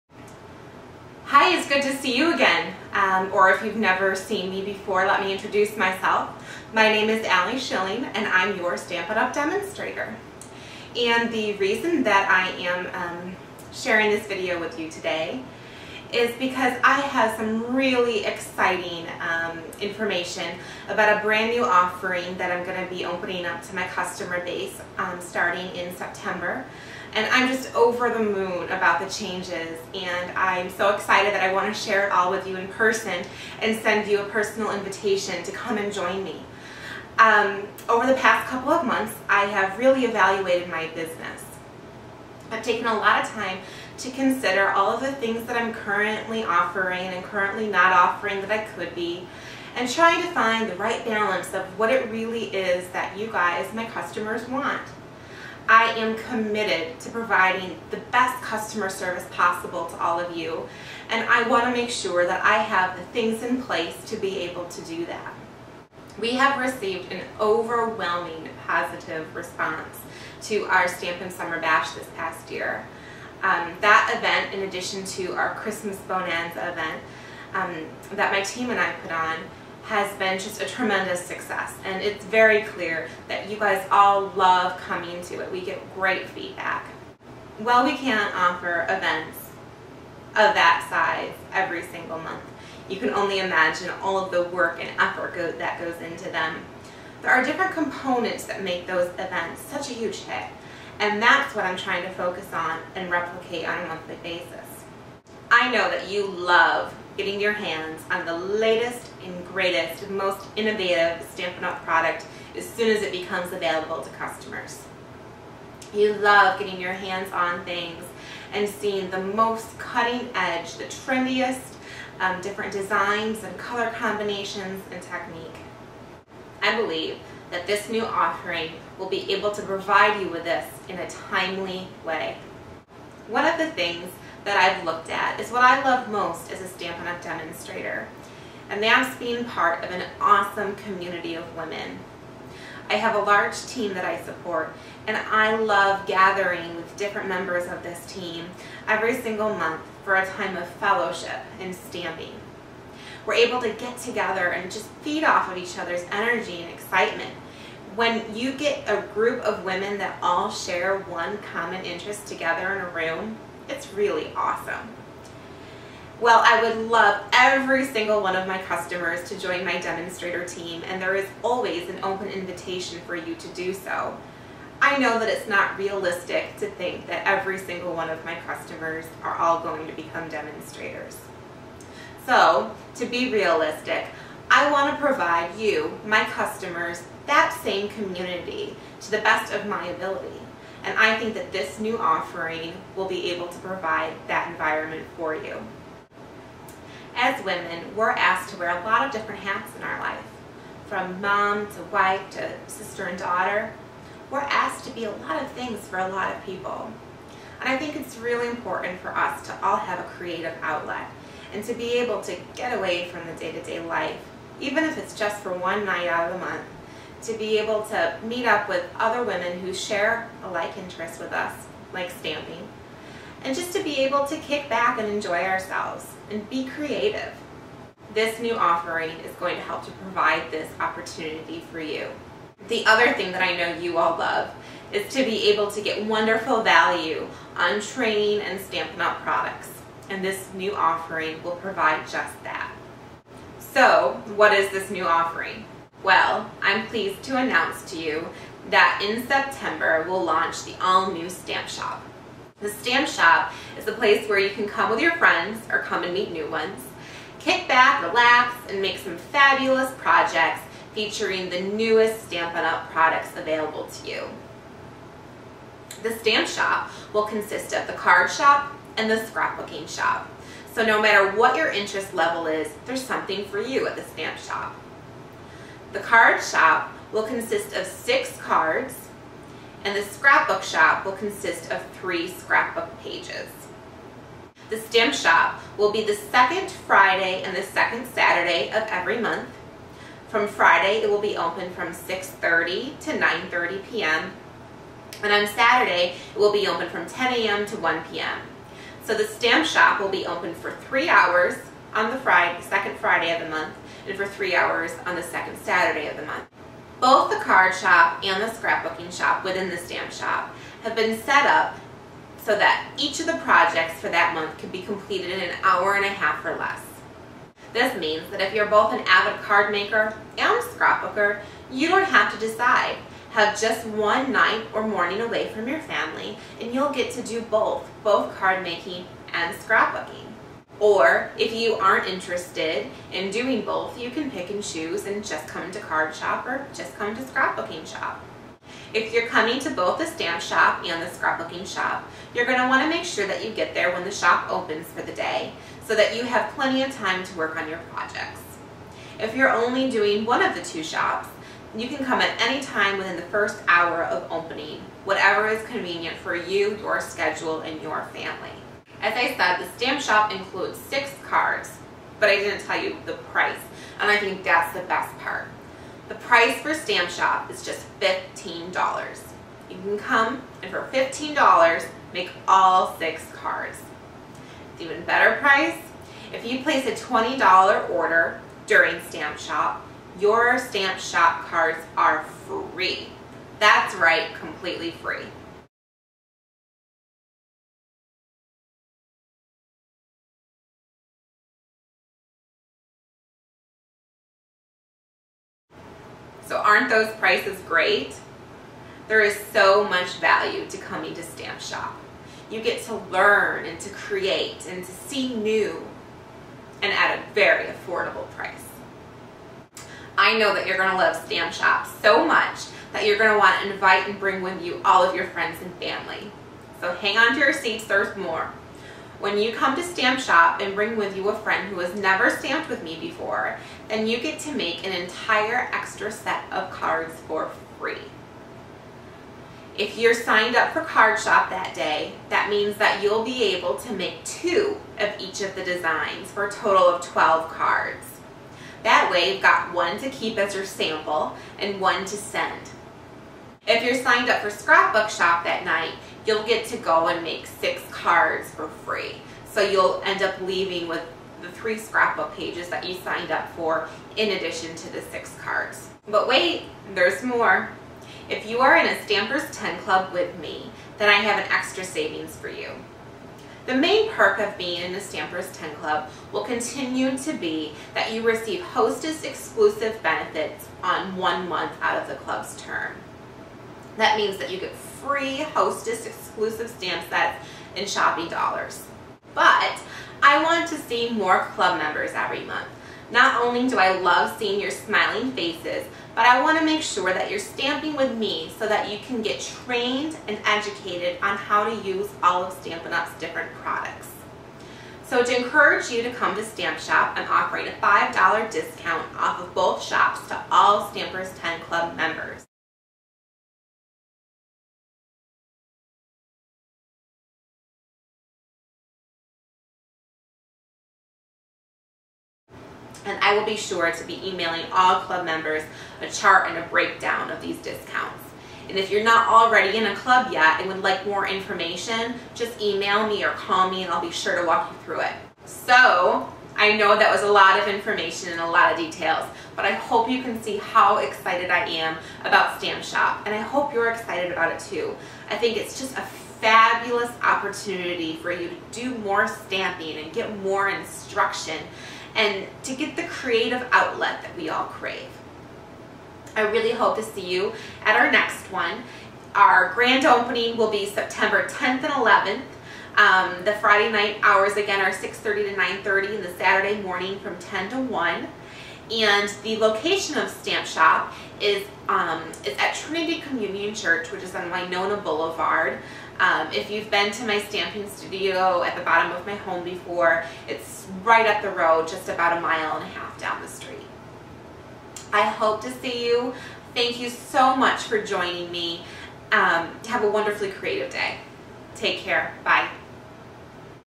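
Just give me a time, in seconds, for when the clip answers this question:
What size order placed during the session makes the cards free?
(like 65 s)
376 s.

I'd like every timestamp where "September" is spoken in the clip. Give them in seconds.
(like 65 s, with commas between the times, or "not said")
25 s, 249 s, 550 s.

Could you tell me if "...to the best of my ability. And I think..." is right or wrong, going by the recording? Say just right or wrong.
right.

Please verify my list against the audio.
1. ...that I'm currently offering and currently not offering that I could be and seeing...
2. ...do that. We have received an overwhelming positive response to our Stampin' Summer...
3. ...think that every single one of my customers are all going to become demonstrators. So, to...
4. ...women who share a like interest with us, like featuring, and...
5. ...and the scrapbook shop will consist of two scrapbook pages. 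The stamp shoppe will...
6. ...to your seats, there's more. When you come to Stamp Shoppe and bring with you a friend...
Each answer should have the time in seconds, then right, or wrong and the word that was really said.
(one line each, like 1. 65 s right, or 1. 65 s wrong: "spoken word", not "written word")
1. 45 s wrong: "trying", not "seeing"
2. 64 s right
3. 176 s right
4. 219 s wrong: "stamping", not "featuring"
5. 279 s wrong: "three", not "two"
6. 417 s right.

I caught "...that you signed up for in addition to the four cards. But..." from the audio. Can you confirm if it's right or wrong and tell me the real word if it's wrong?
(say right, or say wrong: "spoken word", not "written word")
wrong: "six", not "four".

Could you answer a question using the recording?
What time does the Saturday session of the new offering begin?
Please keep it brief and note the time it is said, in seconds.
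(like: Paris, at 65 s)
10 a.m., at 297 s.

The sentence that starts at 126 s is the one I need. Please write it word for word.
I believe that this new offering will be able to provide you with this in a timely way.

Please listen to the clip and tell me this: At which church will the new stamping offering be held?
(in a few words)
Trinity Communion Church.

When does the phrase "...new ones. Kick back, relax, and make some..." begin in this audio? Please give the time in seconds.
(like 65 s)
256 s.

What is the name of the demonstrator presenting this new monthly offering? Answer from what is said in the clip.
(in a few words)
Aly Schilling.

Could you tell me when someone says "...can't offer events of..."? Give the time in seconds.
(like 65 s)
87 s.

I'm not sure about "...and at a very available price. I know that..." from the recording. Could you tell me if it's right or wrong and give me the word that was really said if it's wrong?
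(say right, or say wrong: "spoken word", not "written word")
wrong: "affordable", not "available".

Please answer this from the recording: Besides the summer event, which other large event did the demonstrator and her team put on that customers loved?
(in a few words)
Christmas Bonanza.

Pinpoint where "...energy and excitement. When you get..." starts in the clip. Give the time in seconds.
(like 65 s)
156 s.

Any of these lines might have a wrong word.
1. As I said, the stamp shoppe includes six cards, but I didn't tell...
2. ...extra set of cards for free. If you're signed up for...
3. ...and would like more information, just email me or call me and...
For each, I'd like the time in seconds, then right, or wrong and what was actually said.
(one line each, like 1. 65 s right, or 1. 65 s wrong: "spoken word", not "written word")
1. 359 s right
2. 425 s right
3. 520 s right.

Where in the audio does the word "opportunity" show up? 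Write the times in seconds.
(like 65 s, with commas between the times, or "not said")
230 s, 537 s.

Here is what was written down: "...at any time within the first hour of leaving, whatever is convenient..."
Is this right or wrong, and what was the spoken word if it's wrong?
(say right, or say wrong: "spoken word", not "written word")
wrong: "opening", not "leaving".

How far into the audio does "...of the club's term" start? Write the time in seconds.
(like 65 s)
472 s.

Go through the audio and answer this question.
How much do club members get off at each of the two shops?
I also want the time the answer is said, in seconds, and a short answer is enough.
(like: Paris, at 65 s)
$5, at 497 s.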